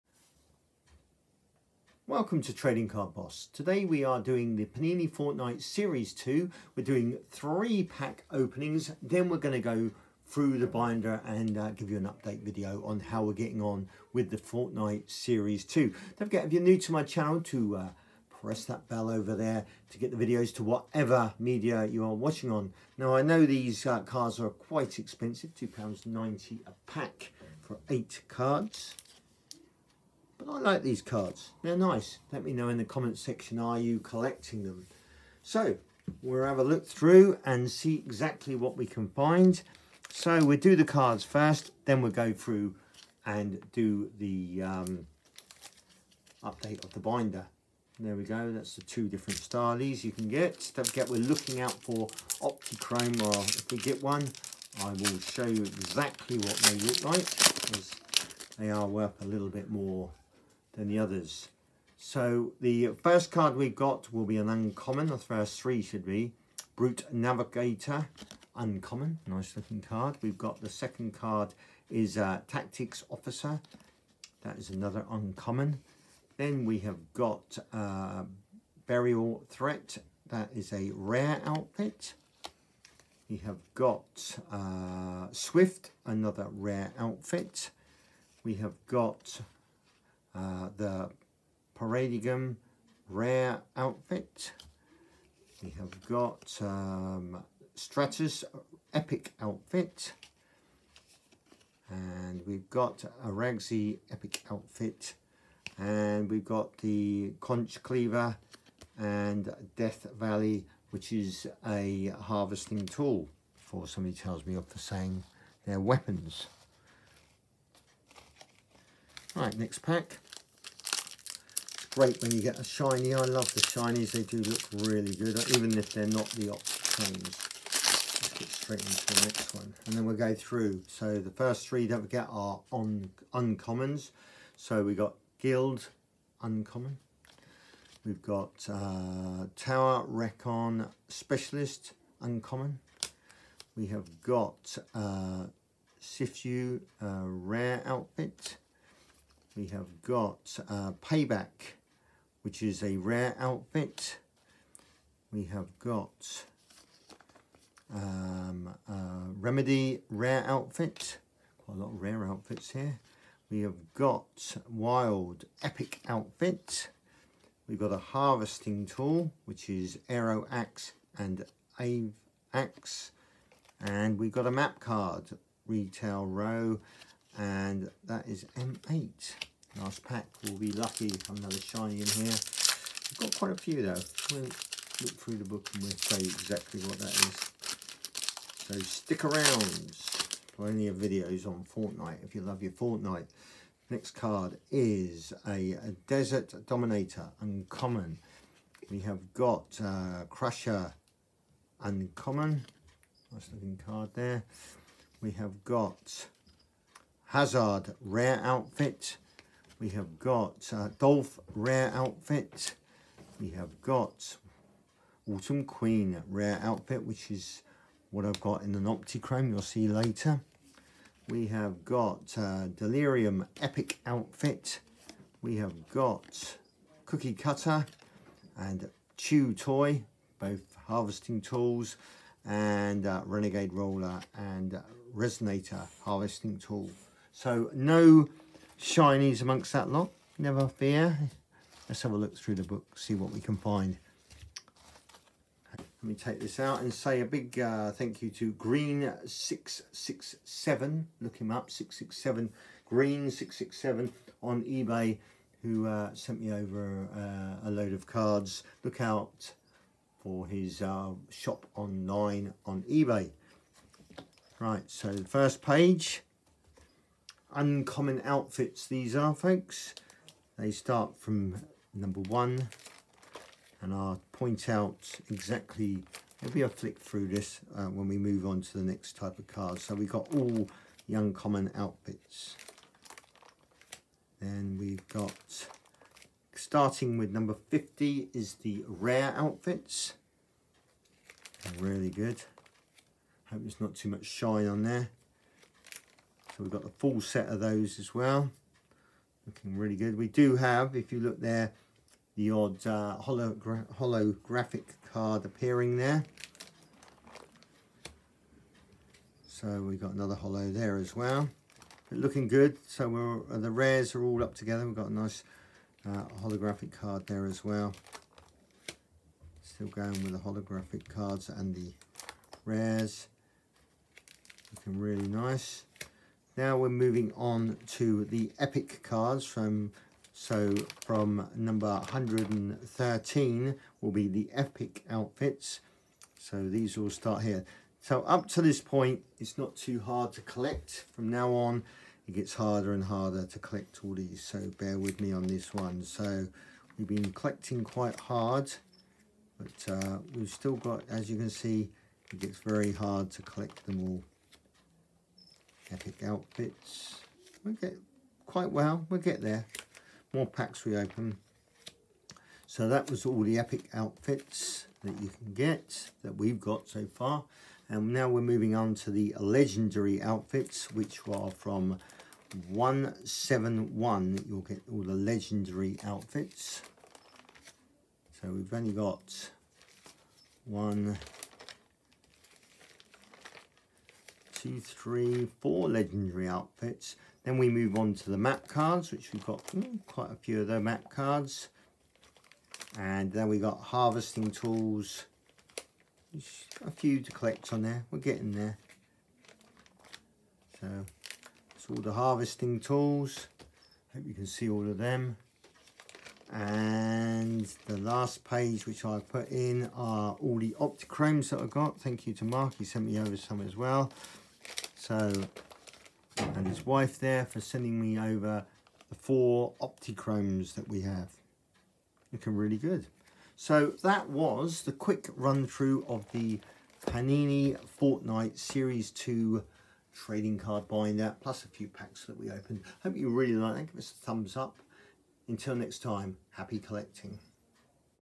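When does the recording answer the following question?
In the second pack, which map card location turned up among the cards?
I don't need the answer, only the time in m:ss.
2:55.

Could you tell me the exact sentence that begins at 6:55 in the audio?
So, and his wife there for sending me over the four Optichromes that we have.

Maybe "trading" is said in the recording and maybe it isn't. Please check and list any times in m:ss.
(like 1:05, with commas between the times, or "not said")
0:02, 7:10.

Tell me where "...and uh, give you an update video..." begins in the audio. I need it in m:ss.
0:11.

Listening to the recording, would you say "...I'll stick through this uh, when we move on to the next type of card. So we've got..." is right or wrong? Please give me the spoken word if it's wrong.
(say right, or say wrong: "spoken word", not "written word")
wrong: "flick", not "stick".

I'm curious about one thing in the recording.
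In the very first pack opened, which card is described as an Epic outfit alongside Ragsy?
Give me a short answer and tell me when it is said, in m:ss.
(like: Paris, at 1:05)
Stratus, at 1:37.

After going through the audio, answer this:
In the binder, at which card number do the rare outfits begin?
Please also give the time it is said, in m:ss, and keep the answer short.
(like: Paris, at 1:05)
50, at 4:47.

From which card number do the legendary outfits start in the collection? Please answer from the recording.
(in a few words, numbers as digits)
171.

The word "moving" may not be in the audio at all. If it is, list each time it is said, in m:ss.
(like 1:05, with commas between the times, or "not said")
5:26, 6:08.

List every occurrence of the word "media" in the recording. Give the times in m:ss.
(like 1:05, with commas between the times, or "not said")
0:21.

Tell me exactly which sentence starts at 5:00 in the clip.
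We do have, if you look there, the odd uh, hologra holographic card appearing there.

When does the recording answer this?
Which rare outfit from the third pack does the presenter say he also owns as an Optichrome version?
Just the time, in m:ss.
3:35.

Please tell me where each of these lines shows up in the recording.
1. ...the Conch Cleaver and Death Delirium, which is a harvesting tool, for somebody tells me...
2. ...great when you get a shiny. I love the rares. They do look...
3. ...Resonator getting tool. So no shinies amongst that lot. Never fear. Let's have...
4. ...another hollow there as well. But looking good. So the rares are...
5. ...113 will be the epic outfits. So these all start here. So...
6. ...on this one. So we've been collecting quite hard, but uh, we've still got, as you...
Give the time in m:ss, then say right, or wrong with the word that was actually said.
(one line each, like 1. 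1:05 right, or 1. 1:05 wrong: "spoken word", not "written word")
1. 1:46 wrong: "Valley", not "Delirium"
2. 2:01 wrong: "shinies", not "rares"
3. 3:55 wrong: "harvesting", not "getting"
4. 5:10 right
5. 5:31 right
6. 5:45 right.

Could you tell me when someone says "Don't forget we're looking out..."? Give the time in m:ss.
0:50.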